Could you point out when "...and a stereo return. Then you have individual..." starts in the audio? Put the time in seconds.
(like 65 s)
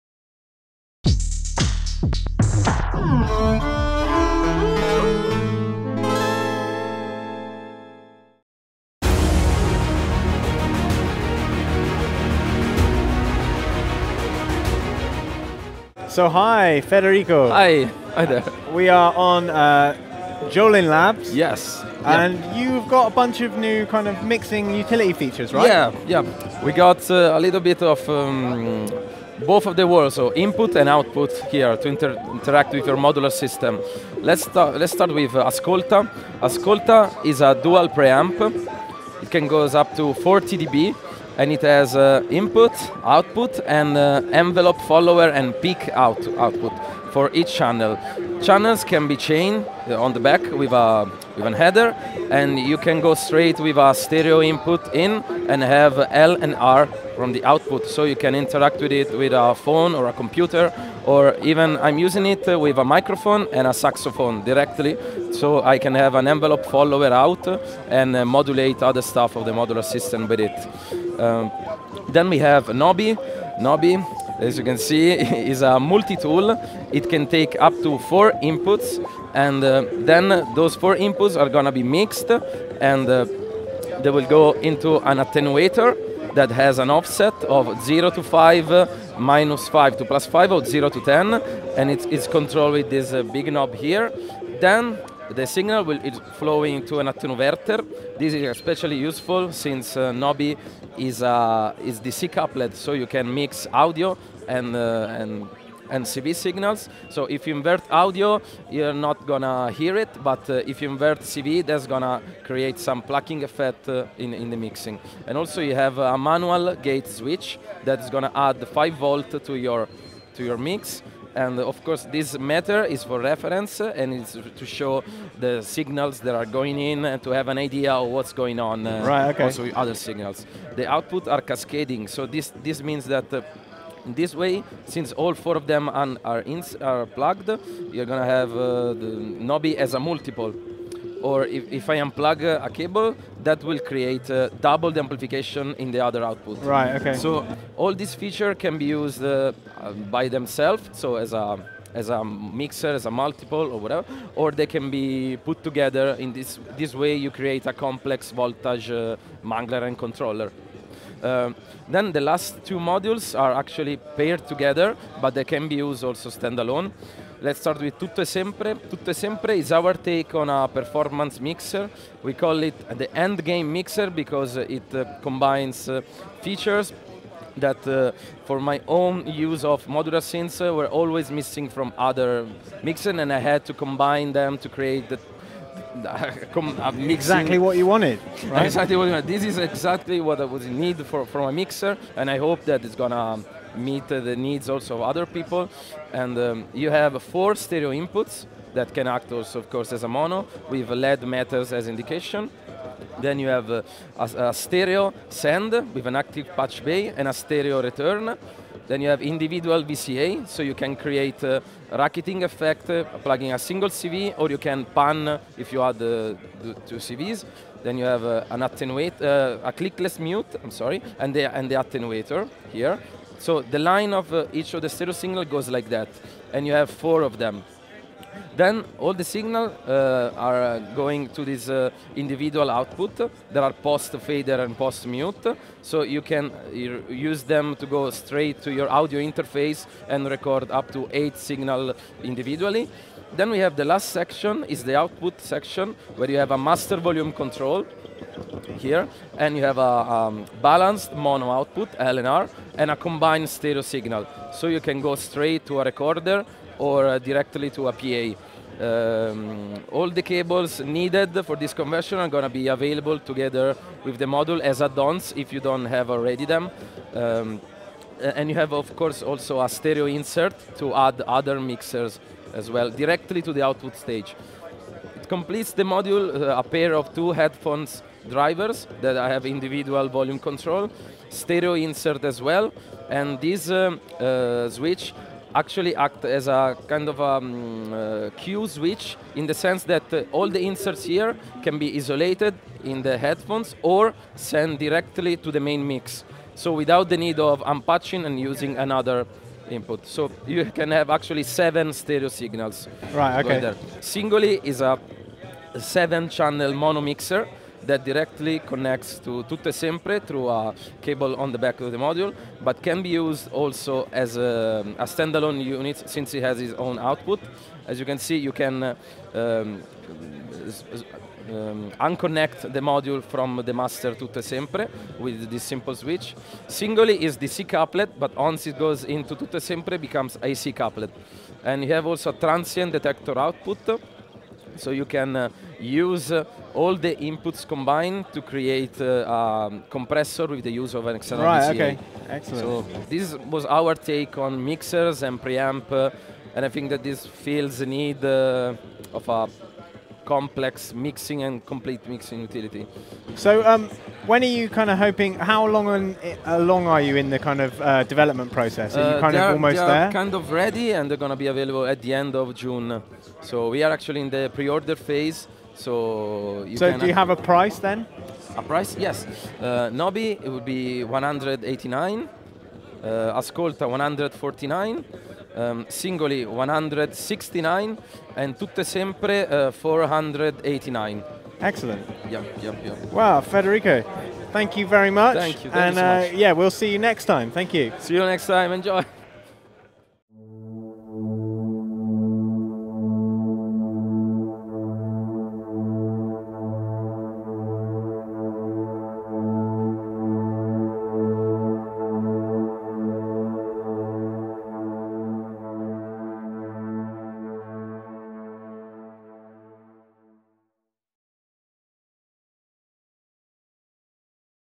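207 s.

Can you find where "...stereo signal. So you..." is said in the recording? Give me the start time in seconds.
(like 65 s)
253 s.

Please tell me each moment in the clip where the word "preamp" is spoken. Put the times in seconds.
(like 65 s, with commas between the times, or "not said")
37 s, 345 s.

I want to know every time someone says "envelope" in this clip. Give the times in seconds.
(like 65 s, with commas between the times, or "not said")
44 s, 66 s.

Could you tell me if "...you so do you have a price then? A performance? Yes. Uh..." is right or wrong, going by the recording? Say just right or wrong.
wrong.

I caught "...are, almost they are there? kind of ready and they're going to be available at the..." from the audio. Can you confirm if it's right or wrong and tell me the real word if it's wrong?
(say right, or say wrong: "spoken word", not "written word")
right.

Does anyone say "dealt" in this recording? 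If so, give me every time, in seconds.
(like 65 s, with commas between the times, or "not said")
not said.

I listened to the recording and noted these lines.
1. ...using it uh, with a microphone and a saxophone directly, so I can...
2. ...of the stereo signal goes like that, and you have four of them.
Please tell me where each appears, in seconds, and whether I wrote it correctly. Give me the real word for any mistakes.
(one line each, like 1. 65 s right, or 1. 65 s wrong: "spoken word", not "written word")
1. 61 s right
2. 224 s right.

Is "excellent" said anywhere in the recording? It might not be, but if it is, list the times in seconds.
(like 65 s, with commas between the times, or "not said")
342 s, 381 s.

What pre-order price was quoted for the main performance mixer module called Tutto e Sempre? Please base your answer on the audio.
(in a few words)
489.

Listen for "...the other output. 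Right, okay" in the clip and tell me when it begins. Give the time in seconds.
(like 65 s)
145 s.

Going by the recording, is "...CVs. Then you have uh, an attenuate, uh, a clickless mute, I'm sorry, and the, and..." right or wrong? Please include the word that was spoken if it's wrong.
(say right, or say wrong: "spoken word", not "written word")
right.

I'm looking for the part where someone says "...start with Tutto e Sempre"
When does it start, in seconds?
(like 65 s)
167 s.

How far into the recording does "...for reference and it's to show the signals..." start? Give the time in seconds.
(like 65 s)
123 s.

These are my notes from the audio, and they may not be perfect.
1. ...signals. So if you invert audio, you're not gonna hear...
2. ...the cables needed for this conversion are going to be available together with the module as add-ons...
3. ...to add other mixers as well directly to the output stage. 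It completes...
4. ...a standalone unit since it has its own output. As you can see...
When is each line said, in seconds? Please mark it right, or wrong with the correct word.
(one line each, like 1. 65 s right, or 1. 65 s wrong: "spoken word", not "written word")
1. 106 s right
2. 260 s right
3. 270 s right
4. 314 s right.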